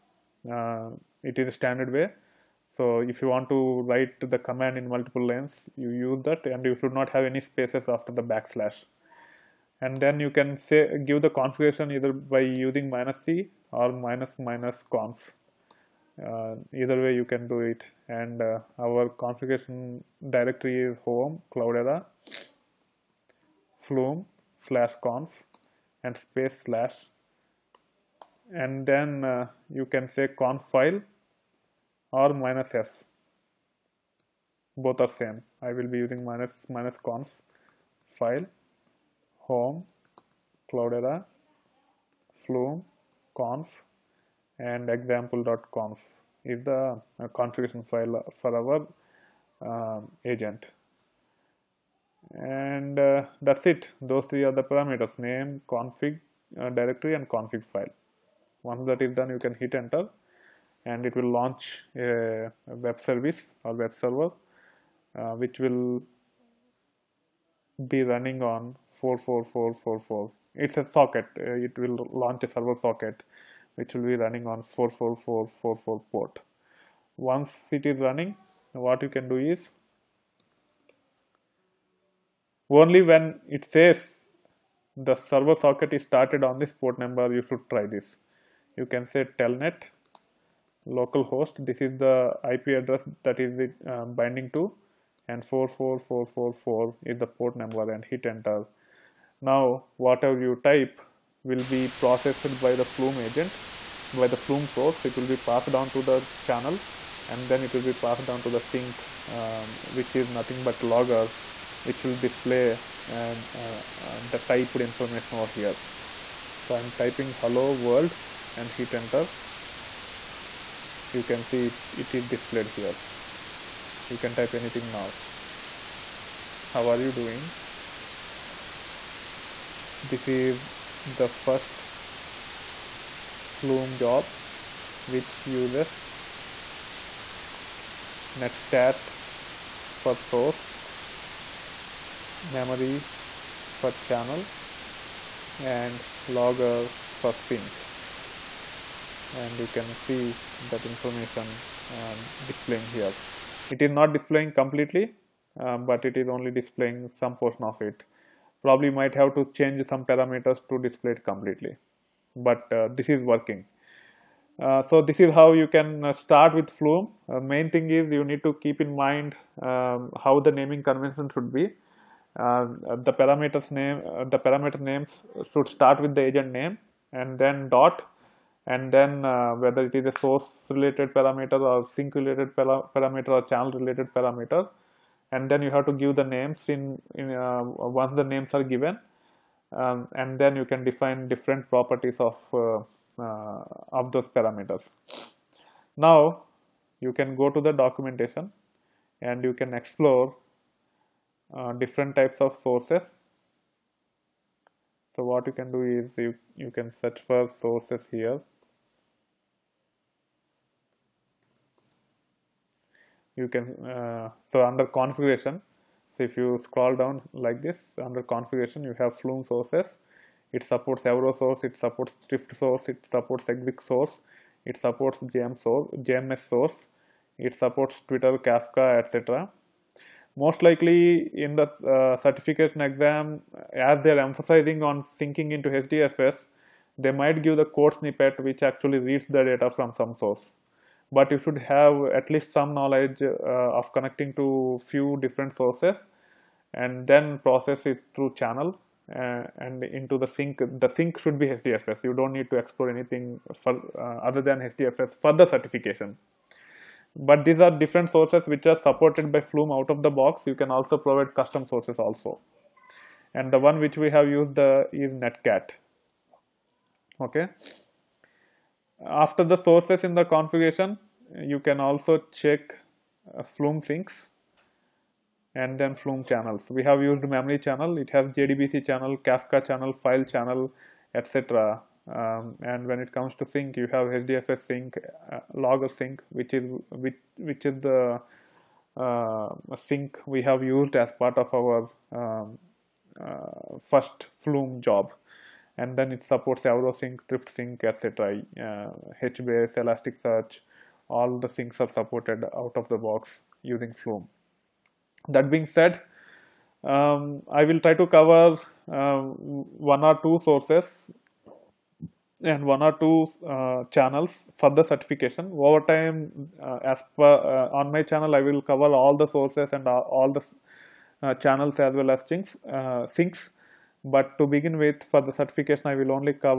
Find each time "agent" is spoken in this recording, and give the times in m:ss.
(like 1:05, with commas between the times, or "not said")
0:50, 1:43, 2:56.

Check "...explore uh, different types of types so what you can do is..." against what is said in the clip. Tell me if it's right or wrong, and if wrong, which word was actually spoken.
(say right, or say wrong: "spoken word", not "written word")
wrong: "sources", not "types".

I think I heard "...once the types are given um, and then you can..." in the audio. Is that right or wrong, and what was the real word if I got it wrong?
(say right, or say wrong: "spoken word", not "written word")
wrong: "names", not "types".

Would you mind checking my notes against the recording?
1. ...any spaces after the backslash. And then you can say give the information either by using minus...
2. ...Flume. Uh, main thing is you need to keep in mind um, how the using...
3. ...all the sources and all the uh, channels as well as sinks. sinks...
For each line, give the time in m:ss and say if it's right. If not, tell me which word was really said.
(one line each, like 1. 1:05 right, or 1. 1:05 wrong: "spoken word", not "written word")
1. 0:07 wrong: "configuration", not "information"
2. 2:46 wrong: "naming", not "using"
3. 5:18 right.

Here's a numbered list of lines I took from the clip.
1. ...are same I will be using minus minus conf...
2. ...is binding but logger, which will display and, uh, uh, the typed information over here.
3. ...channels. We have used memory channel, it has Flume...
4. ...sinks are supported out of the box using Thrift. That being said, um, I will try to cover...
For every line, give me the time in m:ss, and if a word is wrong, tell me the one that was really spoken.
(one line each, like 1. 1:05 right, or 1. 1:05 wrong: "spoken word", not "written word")
1. 0:34 right
2. 1:50 wrong: "nothing", not "binding"
3. 4:36 wrong: "JDBC", not "Flume"
4. 5:01 wrong: "Flume", not "Thrift".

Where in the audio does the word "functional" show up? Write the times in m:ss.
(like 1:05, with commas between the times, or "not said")
not said.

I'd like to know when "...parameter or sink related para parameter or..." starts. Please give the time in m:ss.
3:01.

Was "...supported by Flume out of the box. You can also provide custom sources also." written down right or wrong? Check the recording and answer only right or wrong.
right.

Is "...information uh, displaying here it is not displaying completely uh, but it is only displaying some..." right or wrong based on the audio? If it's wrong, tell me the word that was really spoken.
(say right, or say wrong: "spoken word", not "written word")
right.